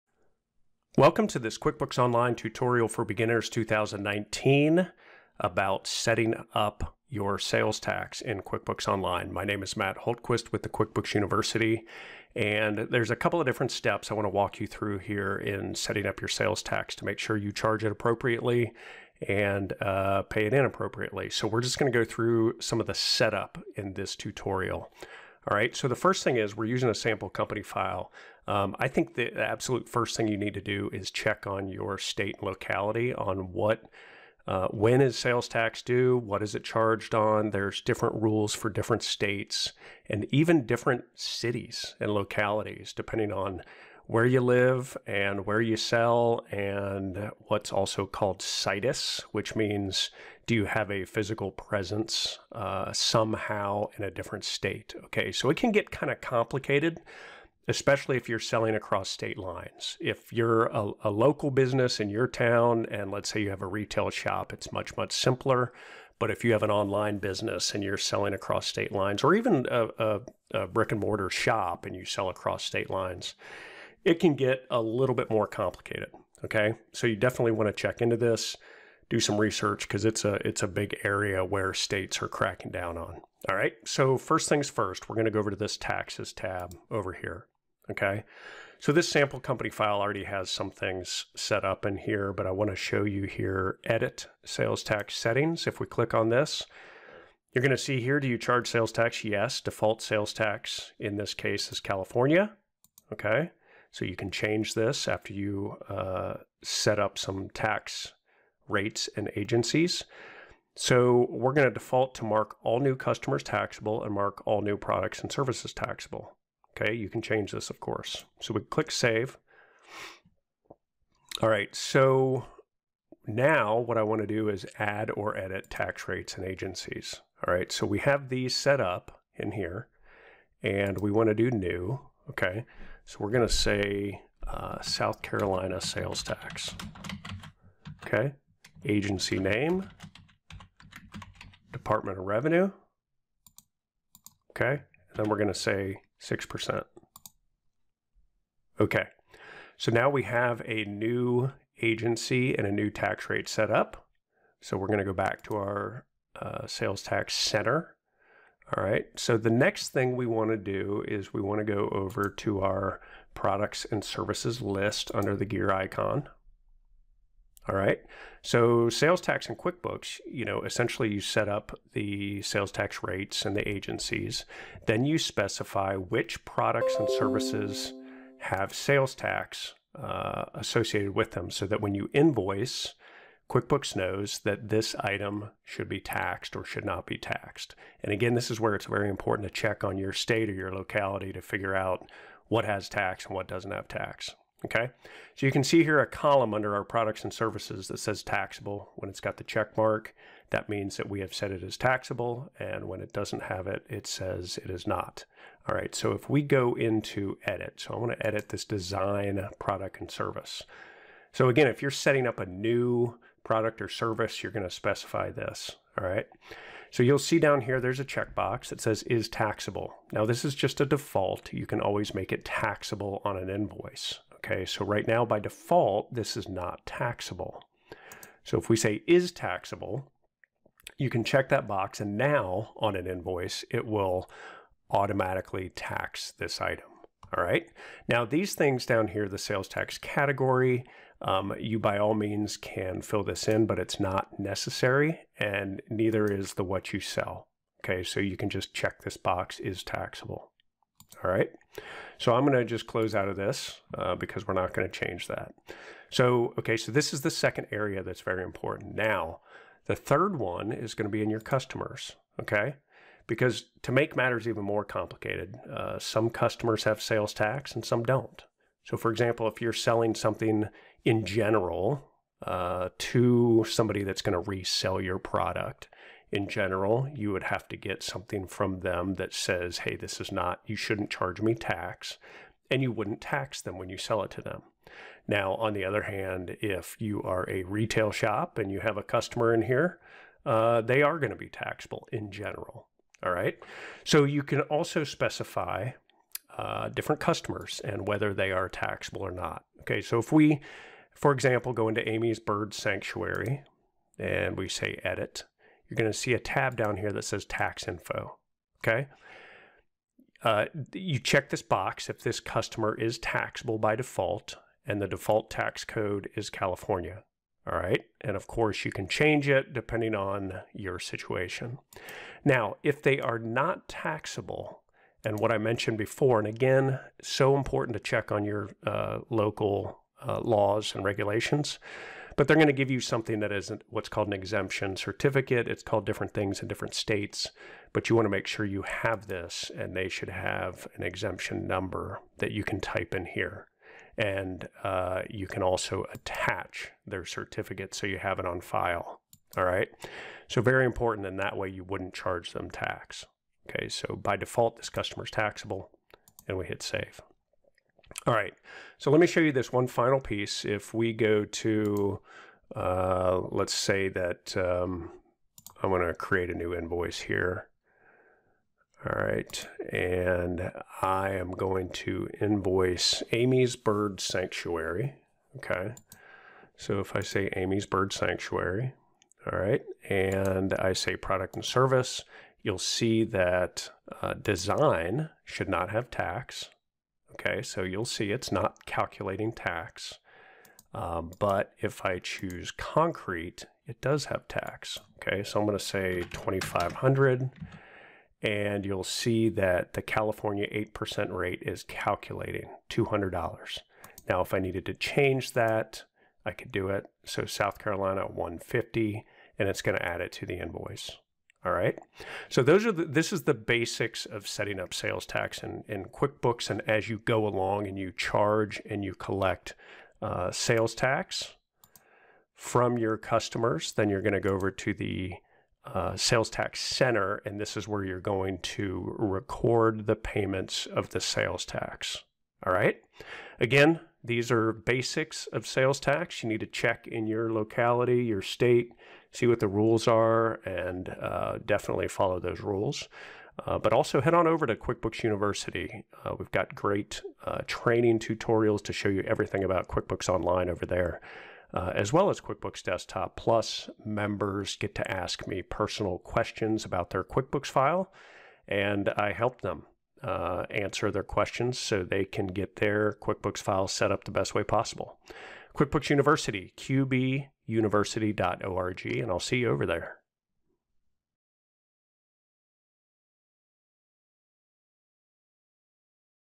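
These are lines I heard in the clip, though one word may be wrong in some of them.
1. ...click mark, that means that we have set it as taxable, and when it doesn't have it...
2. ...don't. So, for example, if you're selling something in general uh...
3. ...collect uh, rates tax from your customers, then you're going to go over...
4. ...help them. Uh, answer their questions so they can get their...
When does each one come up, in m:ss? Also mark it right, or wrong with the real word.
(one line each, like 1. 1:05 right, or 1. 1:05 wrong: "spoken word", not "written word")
1. 3:19 wrong: "check", not "click"
2. 4:28 right
3. 6:59 wrong: "sales", not "rates"
4. 7:39 right.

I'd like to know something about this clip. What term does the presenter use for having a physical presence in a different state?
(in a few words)
situs.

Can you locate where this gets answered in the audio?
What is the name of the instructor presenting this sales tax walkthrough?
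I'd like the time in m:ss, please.
0:09.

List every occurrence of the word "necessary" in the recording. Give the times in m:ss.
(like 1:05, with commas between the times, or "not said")
4:04.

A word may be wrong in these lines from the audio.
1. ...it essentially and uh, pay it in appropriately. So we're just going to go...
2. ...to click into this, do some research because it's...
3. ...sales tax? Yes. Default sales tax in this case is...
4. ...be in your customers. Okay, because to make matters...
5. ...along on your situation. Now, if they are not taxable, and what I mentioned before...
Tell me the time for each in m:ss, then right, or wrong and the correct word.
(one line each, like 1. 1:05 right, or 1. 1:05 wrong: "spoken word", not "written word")
1. 0:17 wrong: "appropriately", not "essentially"
2. 1:17 wrong: "check", not "click"
3. 1:38 right
4. 4:21 right
5. 5:19 wrong: "depending", not "along".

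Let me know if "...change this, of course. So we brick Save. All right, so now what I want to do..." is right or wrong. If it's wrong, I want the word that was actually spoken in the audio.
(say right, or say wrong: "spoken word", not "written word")
wrong: "click", not "brick".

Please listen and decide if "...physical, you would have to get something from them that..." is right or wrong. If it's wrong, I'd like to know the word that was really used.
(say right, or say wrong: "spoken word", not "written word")
wrong: "general", not "physical".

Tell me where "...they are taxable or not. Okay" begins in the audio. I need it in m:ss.
4:58.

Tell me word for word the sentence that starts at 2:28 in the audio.
Okay, so now we have a new agency and a new tax rate set up.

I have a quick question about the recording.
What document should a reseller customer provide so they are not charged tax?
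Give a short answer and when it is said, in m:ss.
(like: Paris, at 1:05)
exemption certificate, at 5:34.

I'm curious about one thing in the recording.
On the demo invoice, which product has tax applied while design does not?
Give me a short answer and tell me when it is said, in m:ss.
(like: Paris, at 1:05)
concrete, at 6:32.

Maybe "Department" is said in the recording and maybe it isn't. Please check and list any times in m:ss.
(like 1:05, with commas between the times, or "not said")
2:21.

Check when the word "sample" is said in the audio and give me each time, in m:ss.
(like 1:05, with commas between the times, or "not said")
0:26, 1:29.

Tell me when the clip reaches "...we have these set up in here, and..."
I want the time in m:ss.
2:07.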